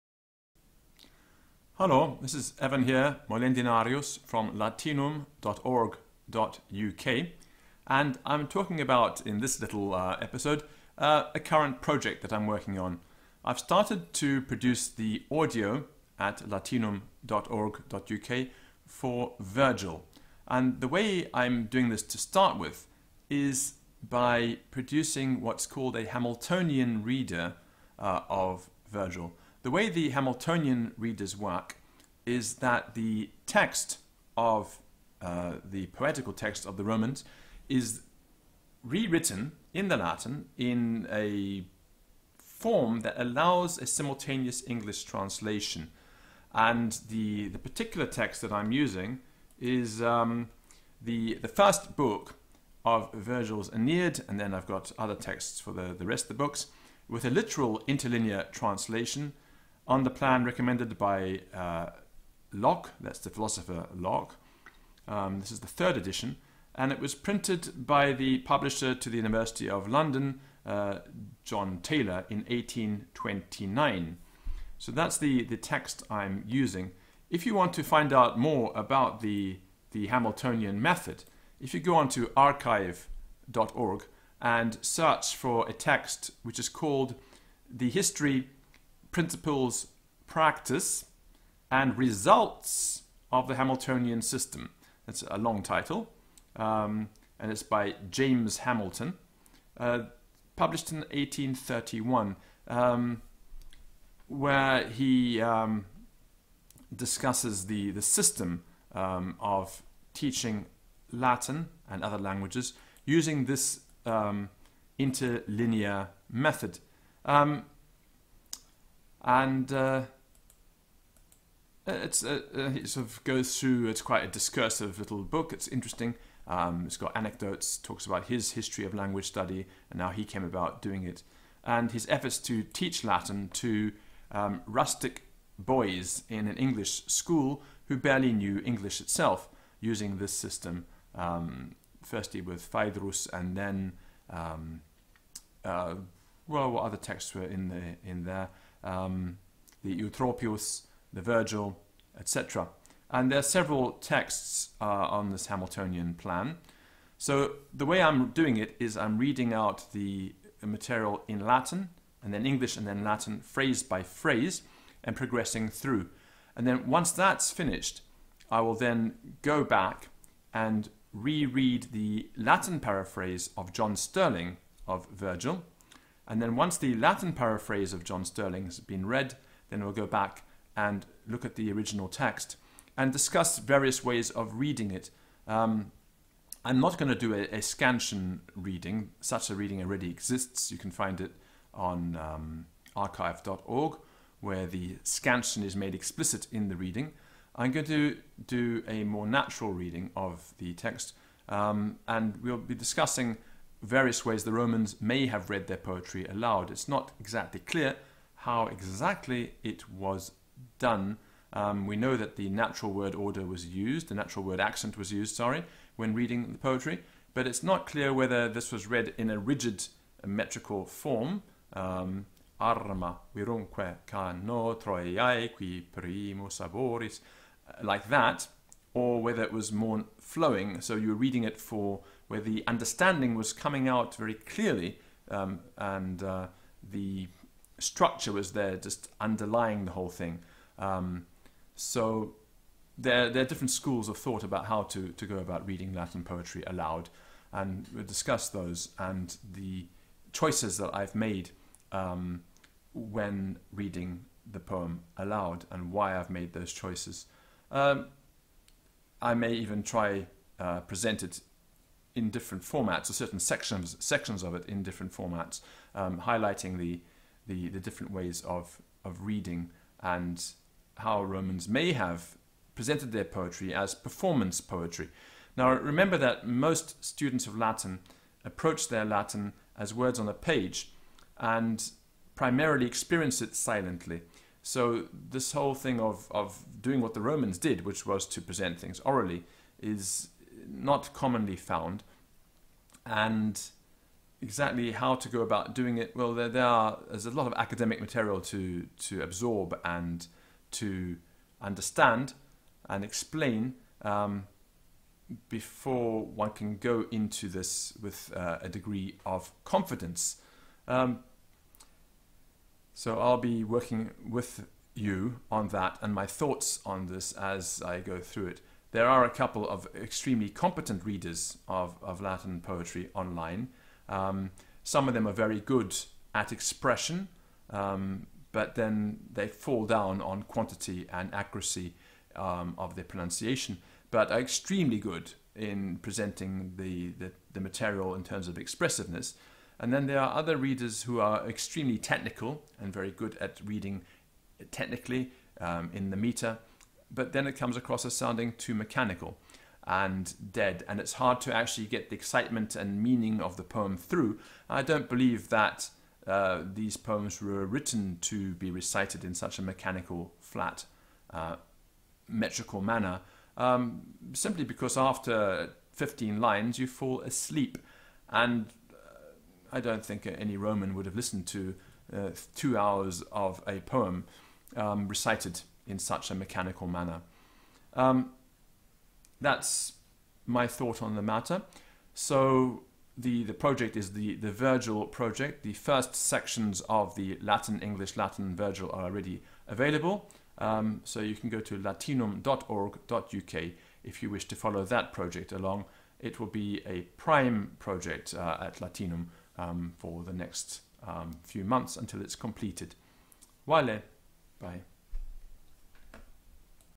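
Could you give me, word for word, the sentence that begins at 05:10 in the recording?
Um, so I'll be working with you on that and my thoughts on this as I go through it.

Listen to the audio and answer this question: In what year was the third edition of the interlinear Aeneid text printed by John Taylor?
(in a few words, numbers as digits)
1829.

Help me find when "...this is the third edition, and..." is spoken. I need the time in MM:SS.
01:05.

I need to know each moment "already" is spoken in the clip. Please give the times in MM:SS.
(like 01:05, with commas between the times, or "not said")
03:09, 06:29.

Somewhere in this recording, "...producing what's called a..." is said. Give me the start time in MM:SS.
00:24.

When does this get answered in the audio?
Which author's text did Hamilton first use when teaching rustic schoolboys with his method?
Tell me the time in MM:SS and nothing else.
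02:22.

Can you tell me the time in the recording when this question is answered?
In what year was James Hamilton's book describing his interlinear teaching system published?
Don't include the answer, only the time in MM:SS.
01:41.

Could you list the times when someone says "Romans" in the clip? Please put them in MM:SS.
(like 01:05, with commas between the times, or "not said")
00:36, 03:24, 04:31, 04:47, 06:10.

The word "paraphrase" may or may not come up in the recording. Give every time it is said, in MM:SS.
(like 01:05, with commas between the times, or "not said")
02:52, 02:57.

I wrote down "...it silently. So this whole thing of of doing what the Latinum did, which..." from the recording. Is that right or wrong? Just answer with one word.
wrong.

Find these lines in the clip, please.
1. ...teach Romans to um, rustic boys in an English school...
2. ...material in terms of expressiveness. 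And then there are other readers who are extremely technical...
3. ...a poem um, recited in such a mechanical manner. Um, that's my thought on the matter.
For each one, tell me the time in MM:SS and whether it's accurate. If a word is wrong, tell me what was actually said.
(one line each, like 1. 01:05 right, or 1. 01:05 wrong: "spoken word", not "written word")
1. 02:12 wrong: "Latin", not "Romans"
2. 05:37 right
3. 06:13 right.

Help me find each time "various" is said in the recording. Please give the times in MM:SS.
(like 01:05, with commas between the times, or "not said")
03:03, 03:23.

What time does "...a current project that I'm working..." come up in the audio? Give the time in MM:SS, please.
00:11.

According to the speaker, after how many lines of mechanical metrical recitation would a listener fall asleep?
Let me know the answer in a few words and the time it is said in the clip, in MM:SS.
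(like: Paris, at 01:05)
15, at 06:05.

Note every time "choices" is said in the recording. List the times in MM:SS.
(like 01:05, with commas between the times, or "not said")
04:10, 04:16.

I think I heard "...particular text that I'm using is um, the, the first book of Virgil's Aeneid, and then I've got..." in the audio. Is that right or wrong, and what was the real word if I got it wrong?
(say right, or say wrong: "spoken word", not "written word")
right.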